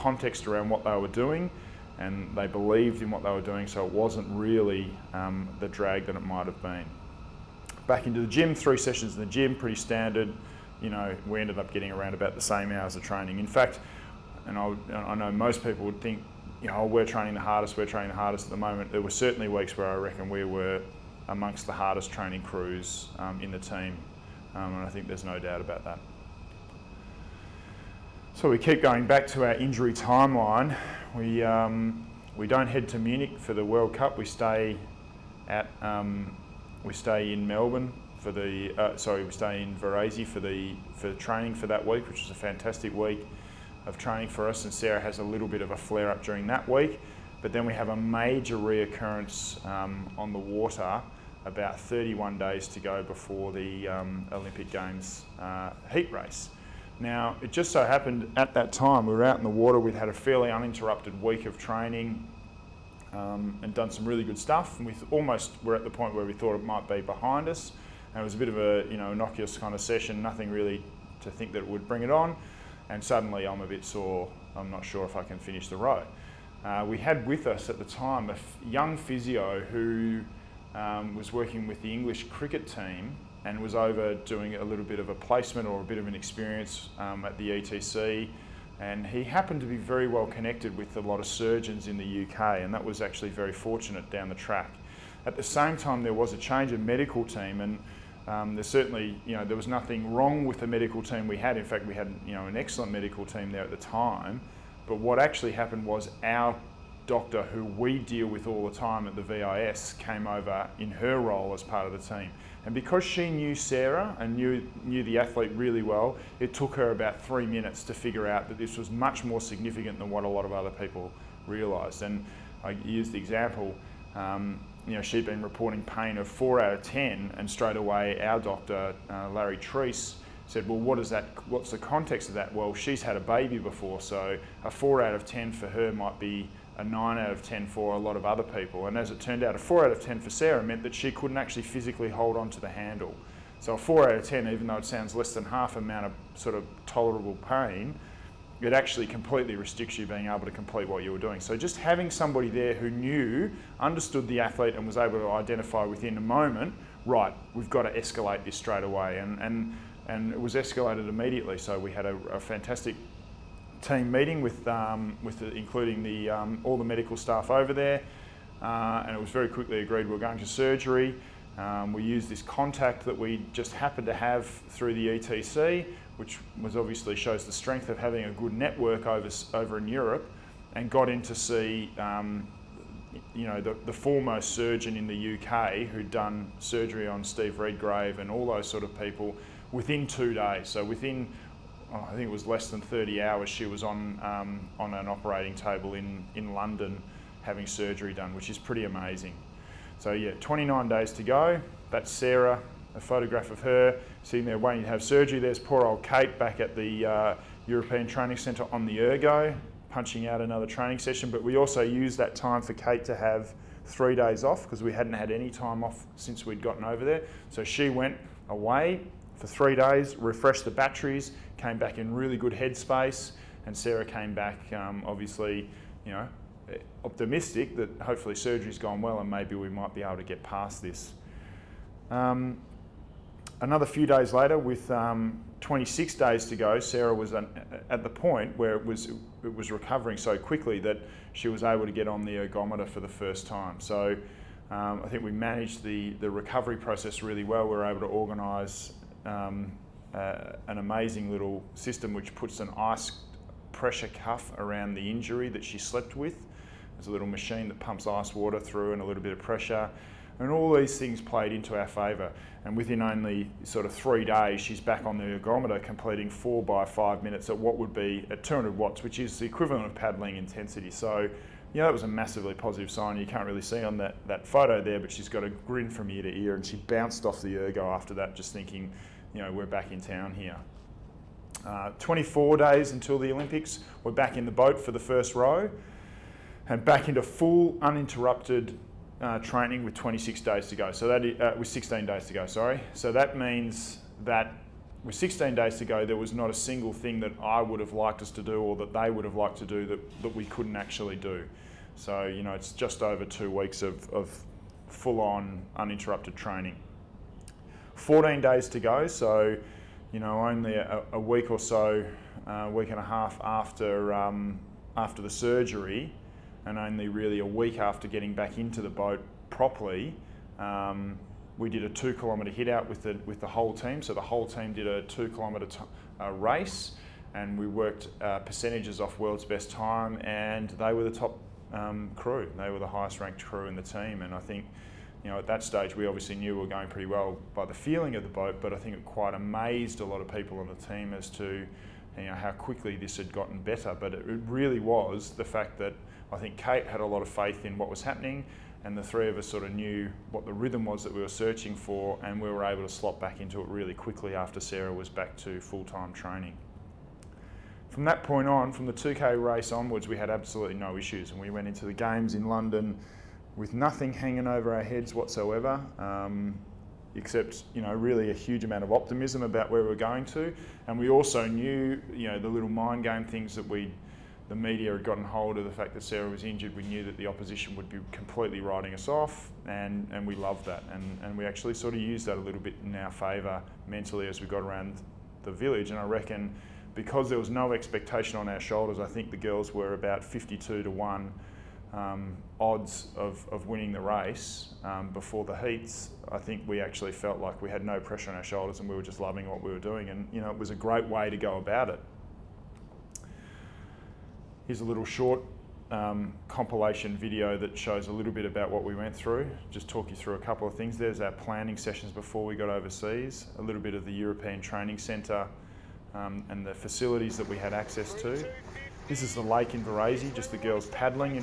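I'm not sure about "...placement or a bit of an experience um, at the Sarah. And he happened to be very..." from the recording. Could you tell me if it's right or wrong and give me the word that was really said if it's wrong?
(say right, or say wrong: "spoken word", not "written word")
wrong: "ETC", not "Sarah".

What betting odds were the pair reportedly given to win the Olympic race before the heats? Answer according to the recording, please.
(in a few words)
52 to 1.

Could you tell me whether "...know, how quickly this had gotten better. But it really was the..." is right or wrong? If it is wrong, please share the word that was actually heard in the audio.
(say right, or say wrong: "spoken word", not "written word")
right.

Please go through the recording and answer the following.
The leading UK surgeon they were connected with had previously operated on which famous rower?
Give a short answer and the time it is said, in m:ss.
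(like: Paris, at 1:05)
Steve Redgrave, at 3:07.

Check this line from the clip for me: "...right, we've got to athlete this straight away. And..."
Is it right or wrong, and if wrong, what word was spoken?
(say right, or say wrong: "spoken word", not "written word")
wrong: "escalate", not "athlete".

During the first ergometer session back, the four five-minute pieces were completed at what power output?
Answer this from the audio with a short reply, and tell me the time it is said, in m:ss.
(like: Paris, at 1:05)
200 watts, at 4:28.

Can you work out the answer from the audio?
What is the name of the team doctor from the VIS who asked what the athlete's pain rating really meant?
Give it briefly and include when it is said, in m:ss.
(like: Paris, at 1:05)
Larry Trease, at 2:09.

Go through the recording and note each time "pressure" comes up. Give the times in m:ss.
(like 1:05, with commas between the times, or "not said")
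4:13, 4:19, 6:37.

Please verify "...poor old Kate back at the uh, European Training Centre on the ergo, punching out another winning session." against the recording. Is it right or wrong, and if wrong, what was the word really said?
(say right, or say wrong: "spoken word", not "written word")
wrong: "training", not "winning".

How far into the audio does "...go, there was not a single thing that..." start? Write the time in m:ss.
4:55.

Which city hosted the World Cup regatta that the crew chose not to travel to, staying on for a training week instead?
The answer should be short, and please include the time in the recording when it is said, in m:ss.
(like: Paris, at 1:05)
Munich, at 0:32.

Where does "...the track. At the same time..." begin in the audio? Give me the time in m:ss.
1:34.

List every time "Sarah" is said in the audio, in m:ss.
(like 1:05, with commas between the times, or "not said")
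0:44, 1:53, 2:20, 3:22, 3:43, 3:56, 5:54, 6:16.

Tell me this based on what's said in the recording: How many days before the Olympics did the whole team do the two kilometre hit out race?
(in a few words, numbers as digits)
14 days.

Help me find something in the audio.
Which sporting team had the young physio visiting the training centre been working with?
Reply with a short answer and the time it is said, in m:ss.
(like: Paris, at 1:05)
English cricket team, at 1:21.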